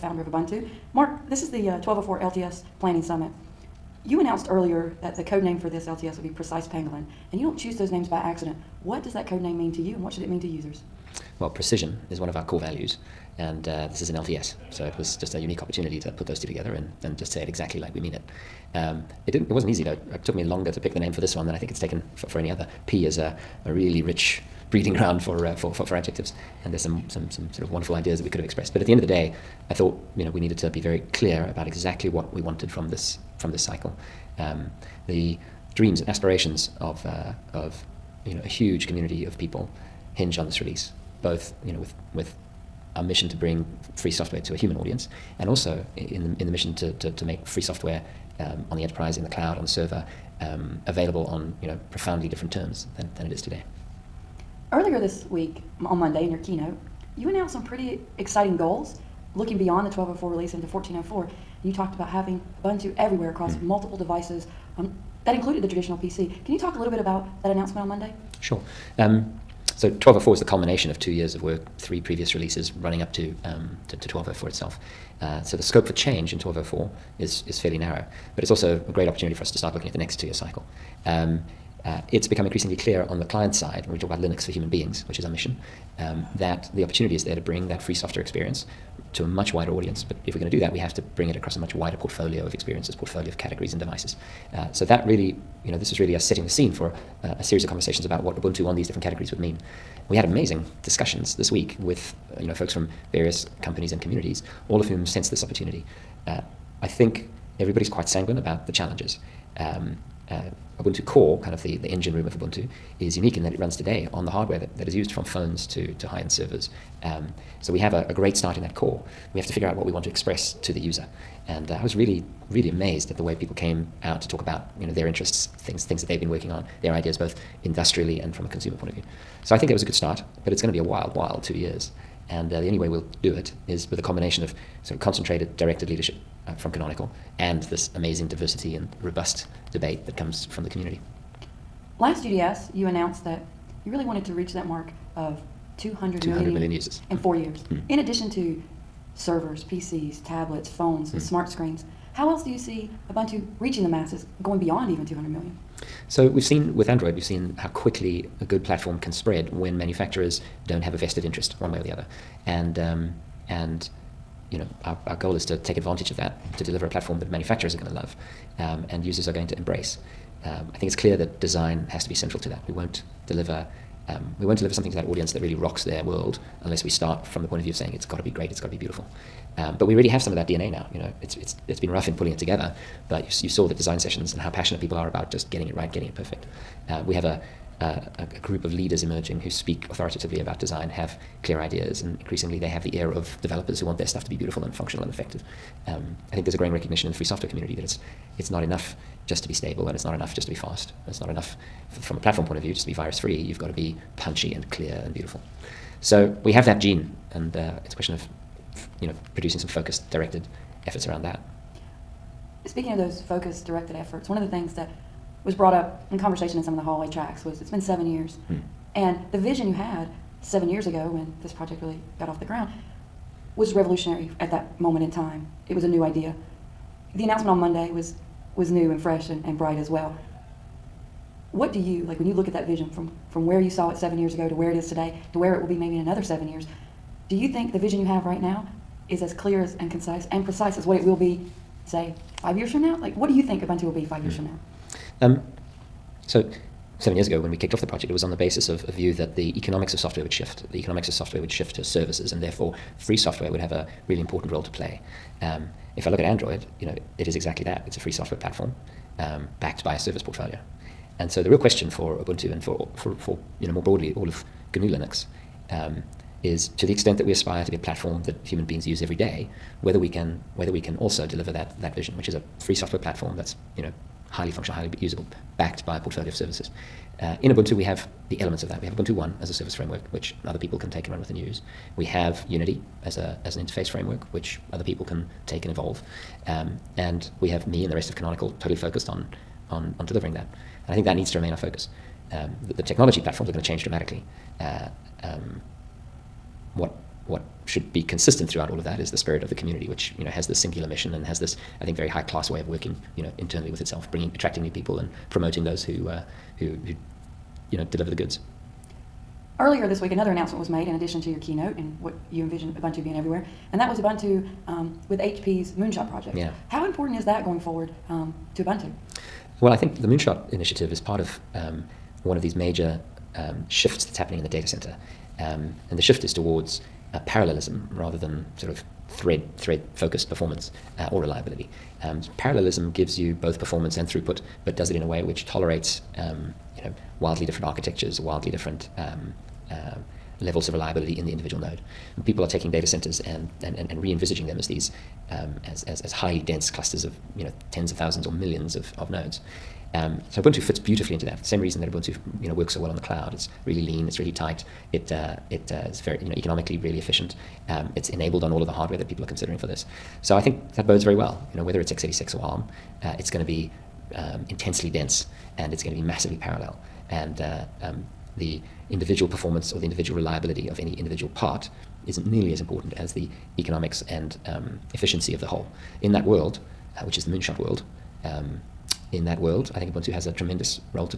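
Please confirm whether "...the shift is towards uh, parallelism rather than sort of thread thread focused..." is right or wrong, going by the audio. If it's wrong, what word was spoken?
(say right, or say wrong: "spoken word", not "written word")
right.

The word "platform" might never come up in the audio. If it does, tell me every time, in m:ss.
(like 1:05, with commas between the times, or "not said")
2:38, 2:46, 3:22, 4:18, 4:27, 4:32, 4:53.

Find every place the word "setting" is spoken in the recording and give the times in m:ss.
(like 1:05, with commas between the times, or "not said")
1:36.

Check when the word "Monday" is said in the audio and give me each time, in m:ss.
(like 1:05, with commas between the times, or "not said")
0:55, 1:07, 3:47.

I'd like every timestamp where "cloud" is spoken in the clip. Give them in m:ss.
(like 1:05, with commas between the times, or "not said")
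0:49, 5:52.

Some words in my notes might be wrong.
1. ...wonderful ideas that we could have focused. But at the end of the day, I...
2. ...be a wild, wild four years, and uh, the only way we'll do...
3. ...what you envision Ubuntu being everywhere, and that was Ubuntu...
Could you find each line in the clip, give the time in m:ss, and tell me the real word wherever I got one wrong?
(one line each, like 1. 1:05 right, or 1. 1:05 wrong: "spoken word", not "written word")
1. 0:27 wrong: "expressed", not "focused"
2. 2:10 wrong: "two", not "four"
3. 5:11 right.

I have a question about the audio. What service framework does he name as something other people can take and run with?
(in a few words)
Ubuntu One.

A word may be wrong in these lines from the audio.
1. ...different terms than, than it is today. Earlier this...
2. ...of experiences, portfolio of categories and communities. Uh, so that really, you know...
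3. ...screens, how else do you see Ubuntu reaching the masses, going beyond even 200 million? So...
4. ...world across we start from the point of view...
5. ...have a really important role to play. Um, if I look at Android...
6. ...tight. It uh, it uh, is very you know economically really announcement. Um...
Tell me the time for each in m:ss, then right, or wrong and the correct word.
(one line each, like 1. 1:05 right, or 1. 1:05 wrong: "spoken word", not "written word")
1. 0:52 right
2. 1:32 wrong: "devices", not "communities"
3. 2:31 right
4. 2:56 wrong: "unless", not "across"
5. 4:13 right
6. 5:54 wrong: "efficient", not "announcement".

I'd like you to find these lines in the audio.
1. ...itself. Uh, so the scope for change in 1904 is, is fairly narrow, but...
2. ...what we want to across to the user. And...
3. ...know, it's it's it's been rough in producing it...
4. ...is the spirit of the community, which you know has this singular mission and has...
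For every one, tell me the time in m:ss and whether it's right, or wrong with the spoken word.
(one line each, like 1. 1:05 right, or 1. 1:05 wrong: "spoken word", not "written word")
1. 1:14 wrong: "1204", not "1904"
2. 1:59 wrong: "express", not "across"
3. 3:00 wrong: "pulling", not "producing"
4. 4:58 right.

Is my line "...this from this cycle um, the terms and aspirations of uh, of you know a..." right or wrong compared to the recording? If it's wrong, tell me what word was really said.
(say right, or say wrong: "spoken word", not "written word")
wrong: "dreams", not "terms".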